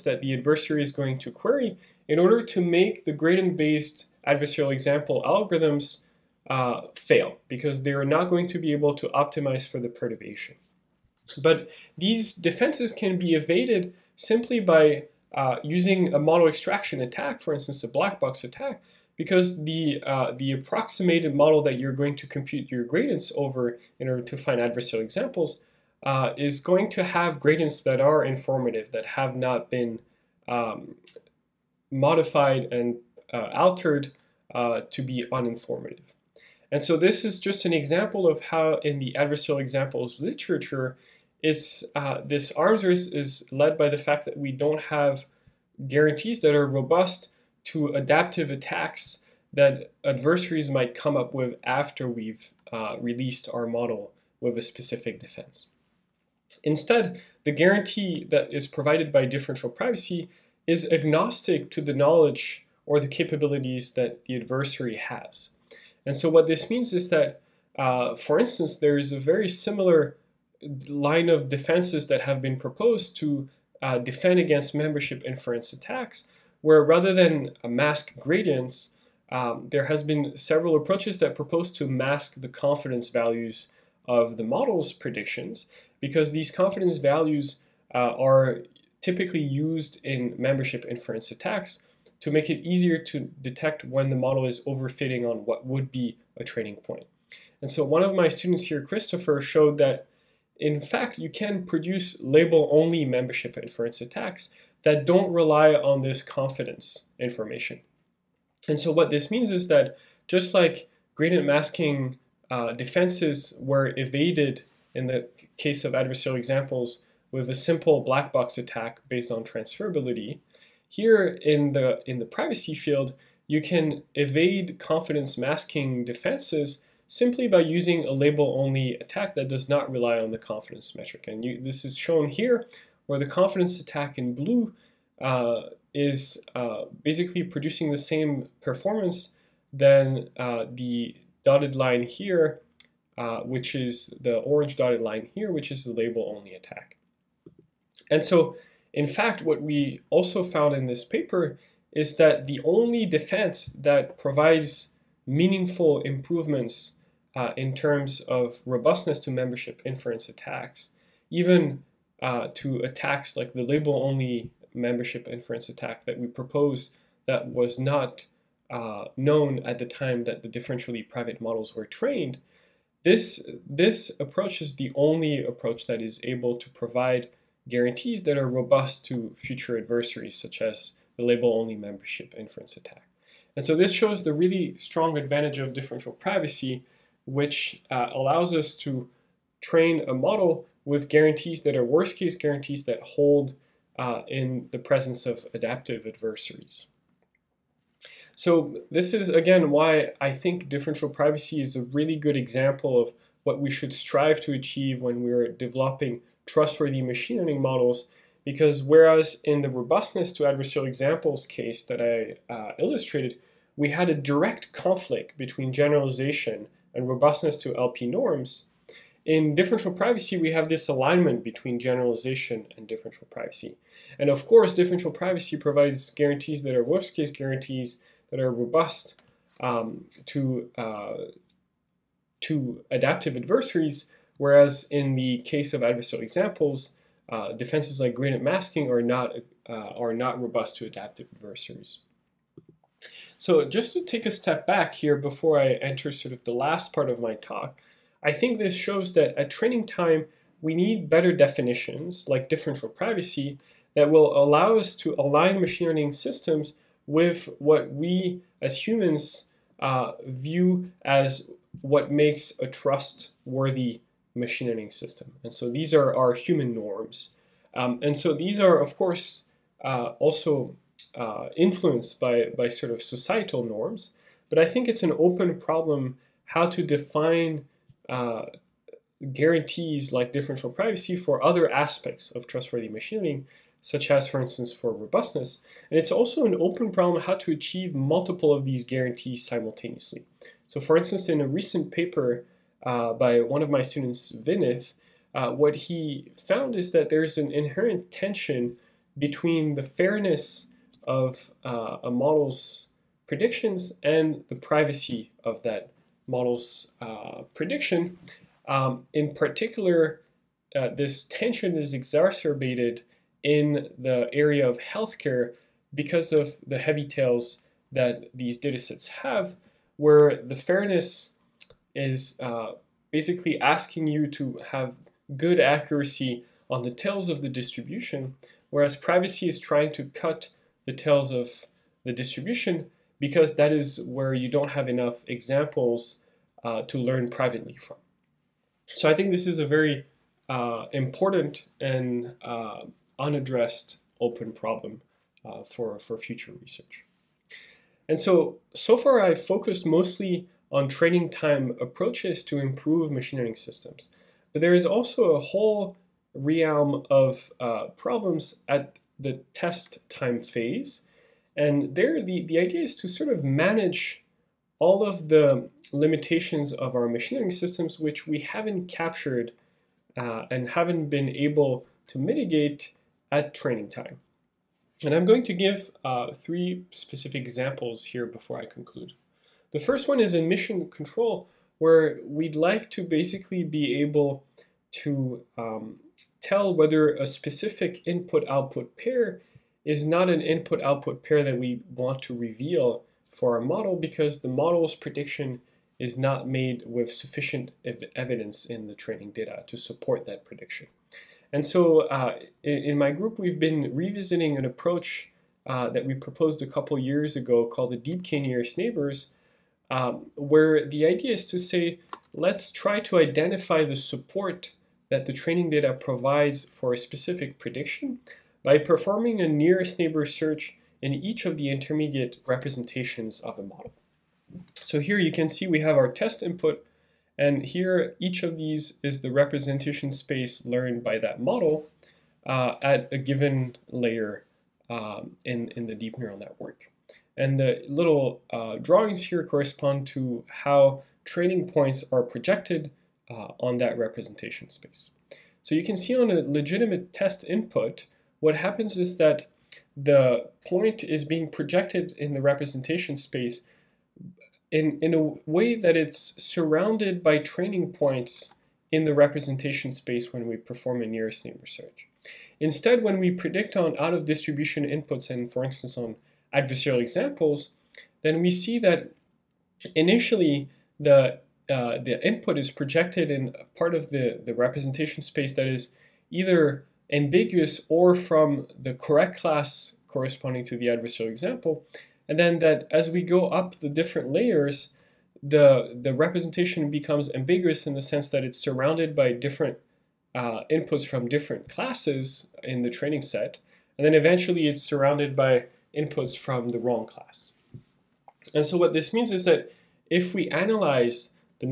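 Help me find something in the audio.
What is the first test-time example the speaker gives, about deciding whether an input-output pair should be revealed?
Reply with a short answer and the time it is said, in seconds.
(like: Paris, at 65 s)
admission control, at 380 s.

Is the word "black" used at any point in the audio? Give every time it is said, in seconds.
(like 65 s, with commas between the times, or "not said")
17 s, 118 s.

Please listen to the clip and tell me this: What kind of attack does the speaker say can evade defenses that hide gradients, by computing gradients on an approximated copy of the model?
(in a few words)
model extraction attack.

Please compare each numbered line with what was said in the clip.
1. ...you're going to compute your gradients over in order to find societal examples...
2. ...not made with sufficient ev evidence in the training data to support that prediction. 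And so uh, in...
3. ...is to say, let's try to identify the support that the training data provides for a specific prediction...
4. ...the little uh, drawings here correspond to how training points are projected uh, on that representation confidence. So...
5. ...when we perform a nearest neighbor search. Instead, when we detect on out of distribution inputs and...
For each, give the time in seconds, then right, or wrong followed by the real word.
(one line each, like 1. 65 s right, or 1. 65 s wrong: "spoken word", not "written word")
1. 21 s wrong: "adversarial", not "societal"
2. 396 s right
3. 411 s right
4. 437 s wrong: "space", not "confidence"
5. 460 s wrong: "predict", not "detect".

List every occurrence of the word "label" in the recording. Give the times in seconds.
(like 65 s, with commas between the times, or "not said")
102 s, 128 s, 145 s, 163 s, 181 s.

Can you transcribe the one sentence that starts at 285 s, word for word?
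And it's also an open problem how to achieve multiple of these guarantees simultaneously.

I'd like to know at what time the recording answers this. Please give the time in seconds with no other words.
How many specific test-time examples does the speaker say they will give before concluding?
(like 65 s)
376 s.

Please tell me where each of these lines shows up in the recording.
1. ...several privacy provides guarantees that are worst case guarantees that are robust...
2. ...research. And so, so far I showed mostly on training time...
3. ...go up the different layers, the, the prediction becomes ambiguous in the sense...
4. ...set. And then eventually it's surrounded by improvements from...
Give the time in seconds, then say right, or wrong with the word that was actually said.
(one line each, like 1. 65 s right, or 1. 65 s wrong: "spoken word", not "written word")
1. 224 s wrong: "differential", not "several"
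2. 346 s wrong: "focused", not "showed"
3. 483 s wrong: "representation", not "prediction"
4. 493 s wrong: "inputs", not "improvements".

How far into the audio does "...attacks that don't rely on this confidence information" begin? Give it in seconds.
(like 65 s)
104 s.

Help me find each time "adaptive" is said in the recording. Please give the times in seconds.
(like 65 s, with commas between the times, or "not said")
47 s, 195 s, 232 s, 240 s.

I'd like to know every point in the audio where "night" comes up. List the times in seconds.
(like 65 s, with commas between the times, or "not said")
not said.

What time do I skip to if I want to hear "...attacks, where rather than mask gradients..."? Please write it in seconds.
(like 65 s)
75 s.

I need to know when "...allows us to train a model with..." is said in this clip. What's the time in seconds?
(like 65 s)
188 s.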